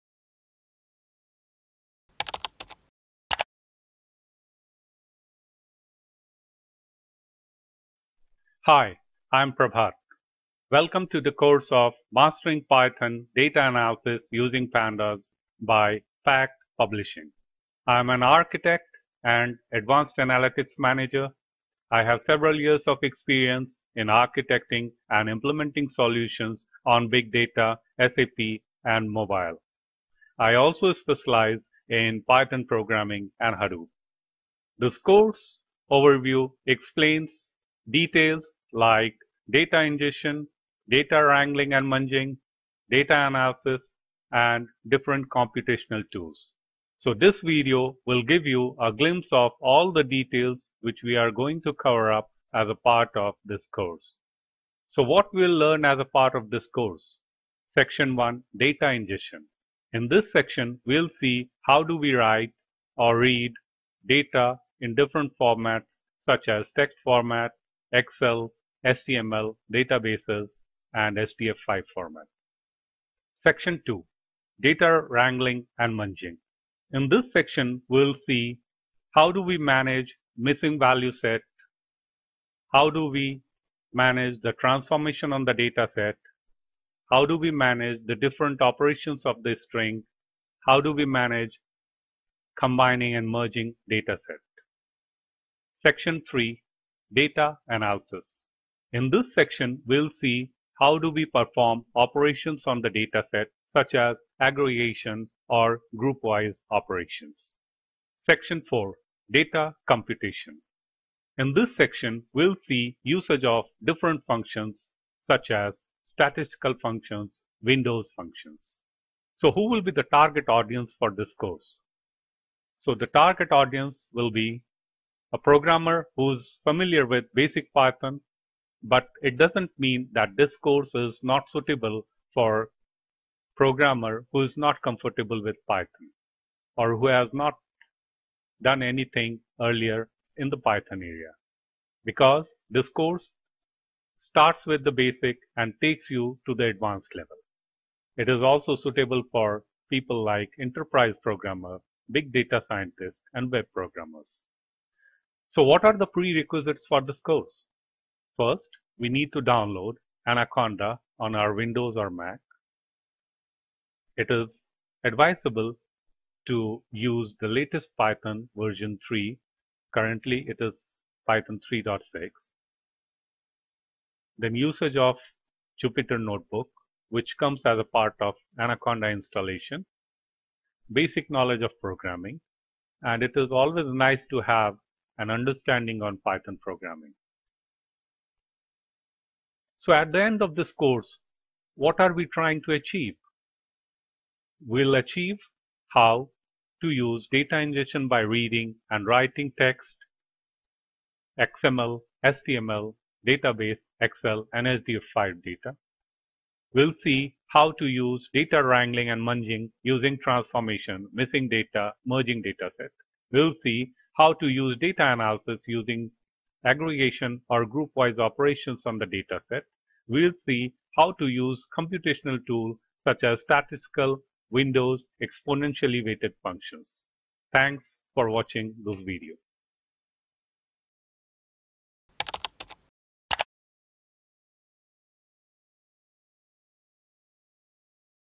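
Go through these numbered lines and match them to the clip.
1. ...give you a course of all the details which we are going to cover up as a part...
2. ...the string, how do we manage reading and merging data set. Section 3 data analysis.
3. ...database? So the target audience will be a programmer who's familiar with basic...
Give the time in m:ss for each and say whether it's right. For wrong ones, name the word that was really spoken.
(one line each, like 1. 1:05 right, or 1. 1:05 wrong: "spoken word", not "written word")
1. 0:48 wrong: "glimpse", not "course"
2. 1:29 wrong: "combining", not "reading"
3. 2:01 wrong: "course", not "database".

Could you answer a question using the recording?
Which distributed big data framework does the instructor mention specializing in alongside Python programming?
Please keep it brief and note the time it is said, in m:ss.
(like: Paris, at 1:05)
Hadoop, at 0:33.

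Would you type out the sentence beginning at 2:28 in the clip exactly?
It is also suitable for people like enterprise programmer, big data scientist, and web programmers.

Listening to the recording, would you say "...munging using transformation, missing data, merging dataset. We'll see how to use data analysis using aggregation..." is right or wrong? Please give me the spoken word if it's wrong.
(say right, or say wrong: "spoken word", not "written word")
right.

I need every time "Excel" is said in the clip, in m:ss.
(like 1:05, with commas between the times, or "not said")
1:07, 3:24.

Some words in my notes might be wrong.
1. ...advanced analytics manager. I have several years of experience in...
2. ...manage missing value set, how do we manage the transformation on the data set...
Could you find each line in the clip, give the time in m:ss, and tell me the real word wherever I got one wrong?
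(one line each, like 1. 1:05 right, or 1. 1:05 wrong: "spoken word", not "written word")
1. 0:19 right
2. 1:19 right.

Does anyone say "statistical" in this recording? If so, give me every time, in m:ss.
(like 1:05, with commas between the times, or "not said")
1:56, 3:43.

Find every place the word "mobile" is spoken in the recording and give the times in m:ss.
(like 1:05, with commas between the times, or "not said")
0:29.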